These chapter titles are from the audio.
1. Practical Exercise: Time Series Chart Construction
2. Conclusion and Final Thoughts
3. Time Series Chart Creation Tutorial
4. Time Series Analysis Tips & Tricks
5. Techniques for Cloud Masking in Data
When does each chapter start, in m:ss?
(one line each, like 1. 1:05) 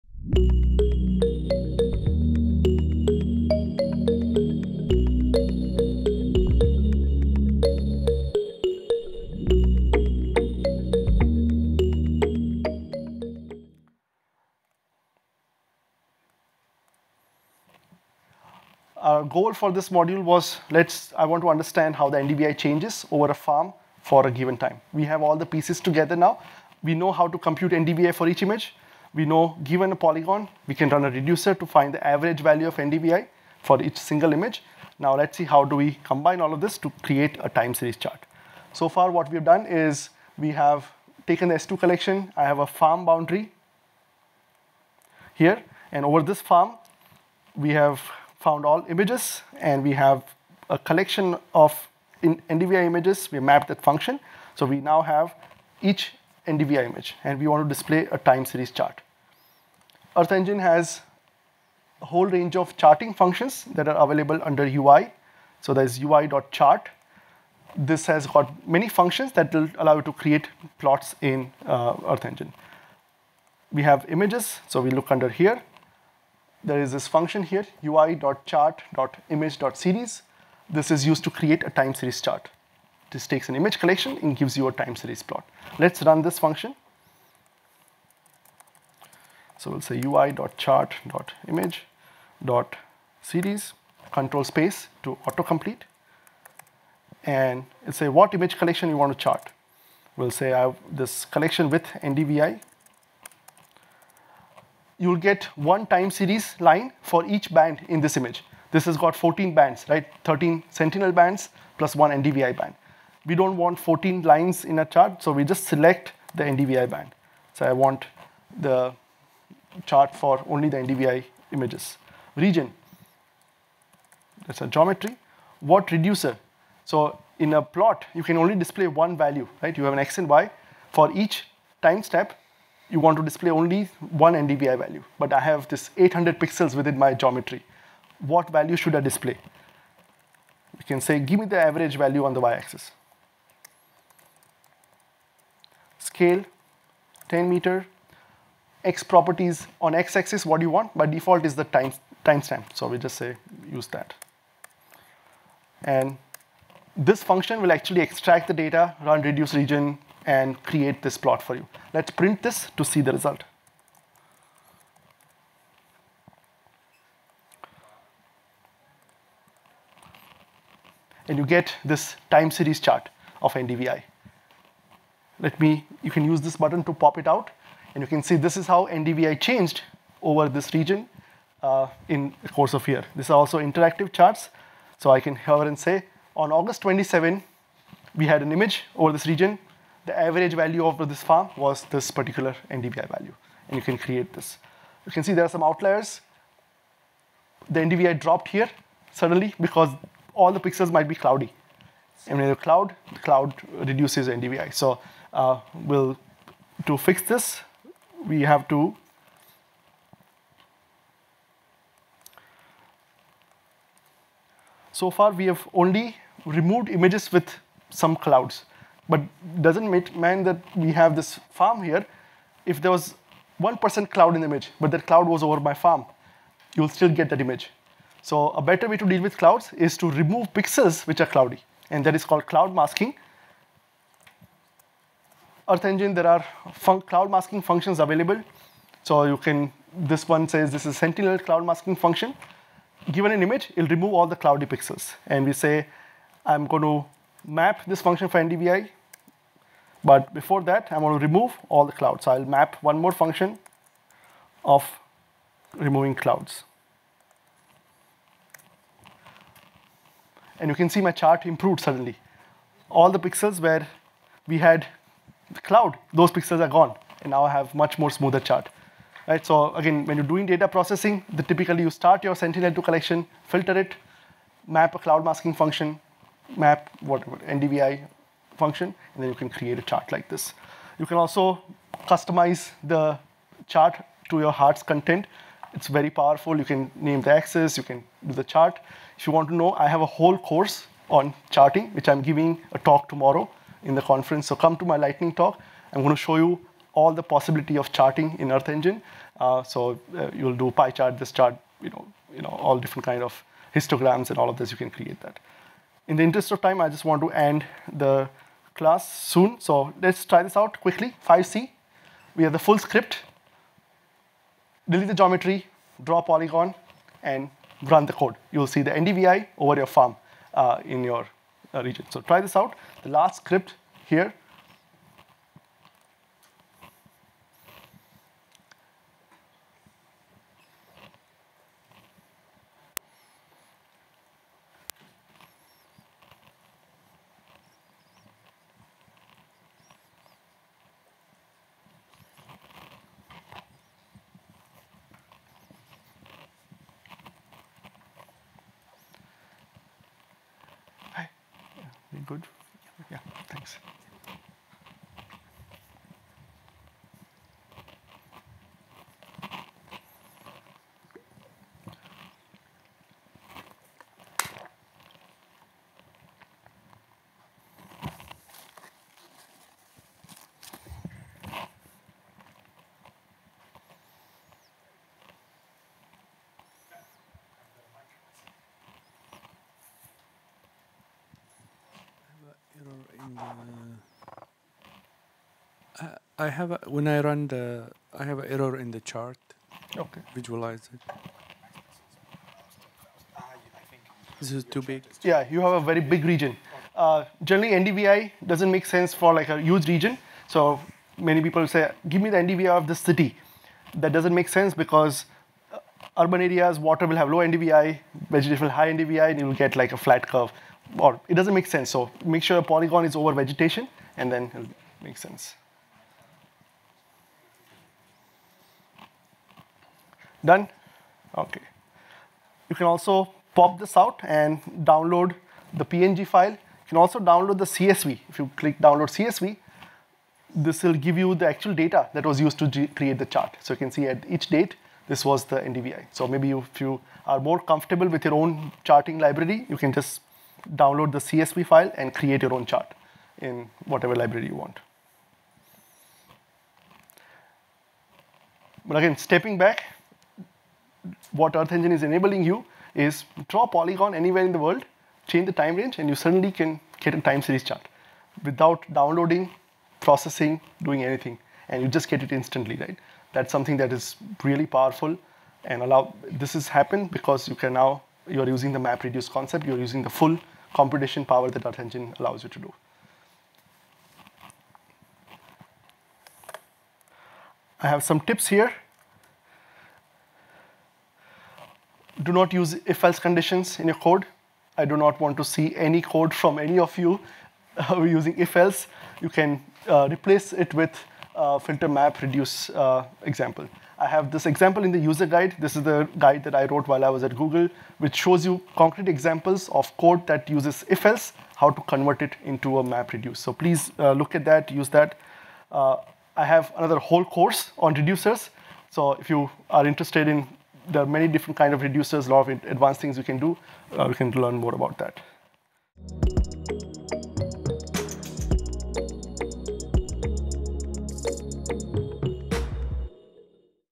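1. 5:51
2. 8:35
3. 0:38
4. 7:57
5. 3:34.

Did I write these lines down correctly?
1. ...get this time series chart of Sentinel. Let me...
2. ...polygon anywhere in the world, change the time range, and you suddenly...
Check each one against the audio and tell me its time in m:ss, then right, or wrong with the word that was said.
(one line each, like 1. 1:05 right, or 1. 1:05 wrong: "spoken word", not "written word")
1. 2:51 wrong: "NDVI", not "Sentinel"
2. 7:33 right.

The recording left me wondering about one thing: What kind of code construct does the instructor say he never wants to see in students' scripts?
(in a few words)
if else conditions.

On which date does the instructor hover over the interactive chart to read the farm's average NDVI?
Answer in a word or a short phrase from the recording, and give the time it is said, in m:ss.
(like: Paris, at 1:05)
August 27, at 3:06.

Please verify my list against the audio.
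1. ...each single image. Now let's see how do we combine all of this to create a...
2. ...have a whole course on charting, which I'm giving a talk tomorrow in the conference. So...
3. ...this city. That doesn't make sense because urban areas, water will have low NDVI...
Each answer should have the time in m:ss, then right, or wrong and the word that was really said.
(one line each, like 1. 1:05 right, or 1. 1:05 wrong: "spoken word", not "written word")
1. 0:33 right
2. 4:49 right
3. 6:42 right.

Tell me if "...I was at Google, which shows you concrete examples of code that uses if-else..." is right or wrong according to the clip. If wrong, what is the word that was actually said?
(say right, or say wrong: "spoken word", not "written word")
right.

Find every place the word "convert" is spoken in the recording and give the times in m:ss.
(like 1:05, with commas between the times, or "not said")
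8:21.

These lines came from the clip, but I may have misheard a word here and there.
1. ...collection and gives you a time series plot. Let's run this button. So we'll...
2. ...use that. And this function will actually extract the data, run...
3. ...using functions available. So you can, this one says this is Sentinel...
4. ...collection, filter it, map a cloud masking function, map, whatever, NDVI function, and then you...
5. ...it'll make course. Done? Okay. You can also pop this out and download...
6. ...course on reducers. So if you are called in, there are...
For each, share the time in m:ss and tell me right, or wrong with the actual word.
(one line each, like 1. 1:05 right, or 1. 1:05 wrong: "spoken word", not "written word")
1. 1:23 wrong: "function", not "button"
2. 2:33 right
3. 3:57 wrong: "masking", not "using"
4. 4:32 right
5. 6:54 wrong: "sense", not "course"
6. 8:27 wrong: "interested", not "called".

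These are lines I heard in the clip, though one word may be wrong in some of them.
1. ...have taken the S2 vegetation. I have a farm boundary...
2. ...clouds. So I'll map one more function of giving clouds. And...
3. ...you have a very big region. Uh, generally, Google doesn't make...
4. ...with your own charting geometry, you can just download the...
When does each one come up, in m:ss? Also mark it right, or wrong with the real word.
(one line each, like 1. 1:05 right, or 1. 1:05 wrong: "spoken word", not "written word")
1. 0:40 wrong: "collection", not "vegetation"
2. 4:11 wrong: "removing", not "giving"
3. 6:35 wrong: "NDVI", not "Google"
4. 7:18 wrong: "library", not "geometry".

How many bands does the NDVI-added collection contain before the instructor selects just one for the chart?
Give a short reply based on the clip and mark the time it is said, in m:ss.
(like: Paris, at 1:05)
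14, at 1:49.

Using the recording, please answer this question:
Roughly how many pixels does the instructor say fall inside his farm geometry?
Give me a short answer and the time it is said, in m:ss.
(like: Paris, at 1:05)
800, at 2:15.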